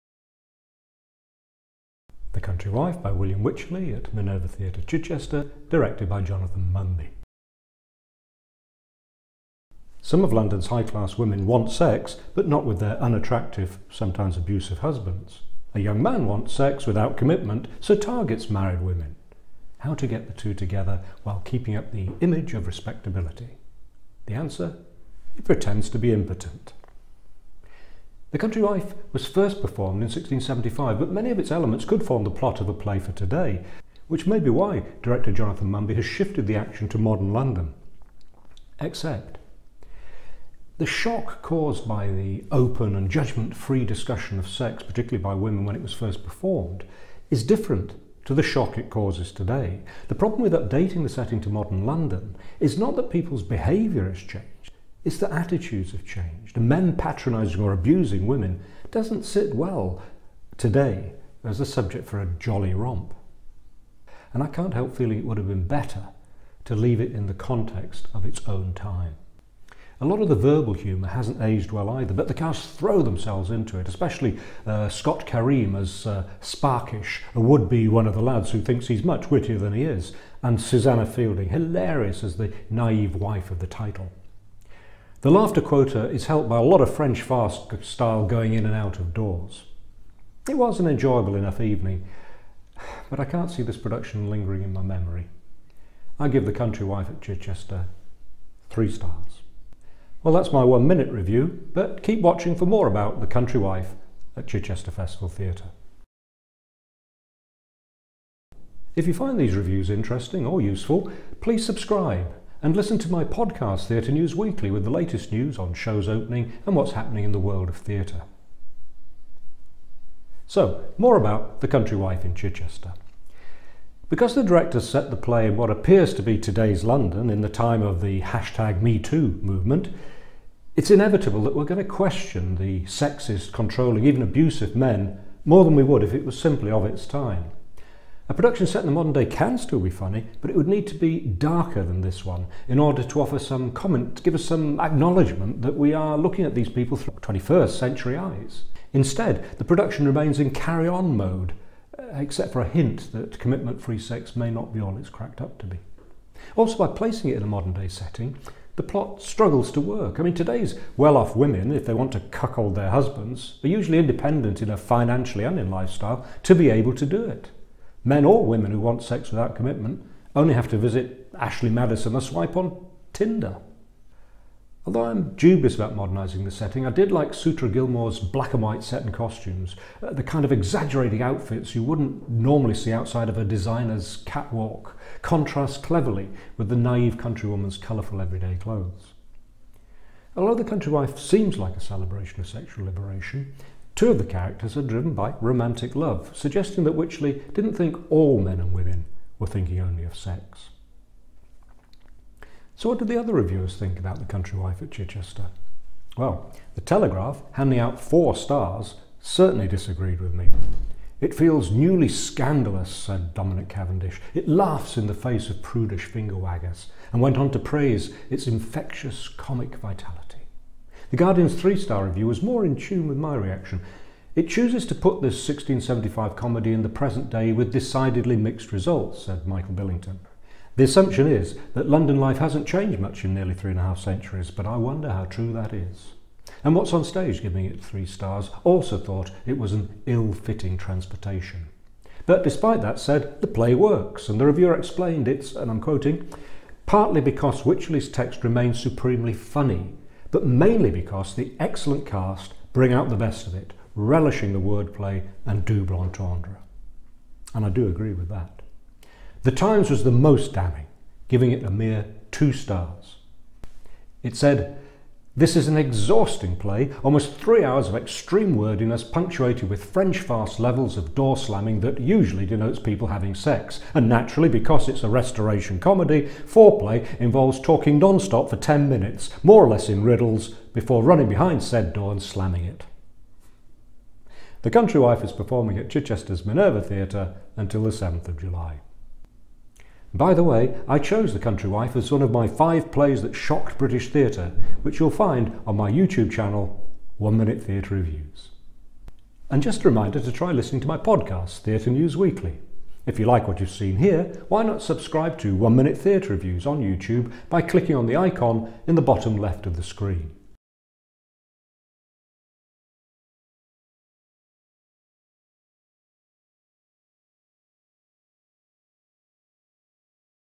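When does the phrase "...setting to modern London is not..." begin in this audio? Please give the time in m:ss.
0:51.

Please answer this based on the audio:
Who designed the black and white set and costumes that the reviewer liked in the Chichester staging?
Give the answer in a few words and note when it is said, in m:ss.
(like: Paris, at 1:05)
Sutra Gilmour, at 2:57.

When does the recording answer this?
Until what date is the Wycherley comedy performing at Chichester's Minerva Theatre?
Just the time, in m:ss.
4:47.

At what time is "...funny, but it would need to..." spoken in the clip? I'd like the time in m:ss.
2:19.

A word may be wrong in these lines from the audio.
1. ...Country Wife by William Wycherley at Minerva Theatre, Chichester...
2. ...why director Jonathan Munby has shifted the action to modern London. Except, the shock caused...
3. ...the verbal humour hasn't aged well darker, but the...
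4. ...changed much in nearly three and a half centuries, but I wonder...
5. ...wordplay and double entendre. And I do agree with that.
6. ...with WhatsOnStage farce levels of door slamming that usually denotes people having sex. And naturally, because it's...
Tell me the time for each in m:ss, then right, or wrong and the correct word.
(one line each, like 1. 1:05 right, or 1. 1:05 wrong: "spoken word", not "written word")
1. 0:02 right
2. 0:34 right
3. 1:10 wrong: "either", not "darker"
4. 3:52 right
5. 4:14 right
6. 4:29 wrong: "French", not "WhatsOnStage".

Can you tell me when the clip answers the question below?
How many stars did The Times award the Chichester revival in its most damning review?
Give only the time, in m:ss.
4:22.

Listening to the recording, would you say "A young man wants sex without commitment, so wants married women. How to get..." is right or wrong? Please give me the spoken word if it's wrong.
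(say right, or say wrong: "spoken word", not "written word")
wrong: "targets", not "wants".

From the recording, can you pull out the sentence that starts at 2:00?
So, more about The Country Wife in Chichester.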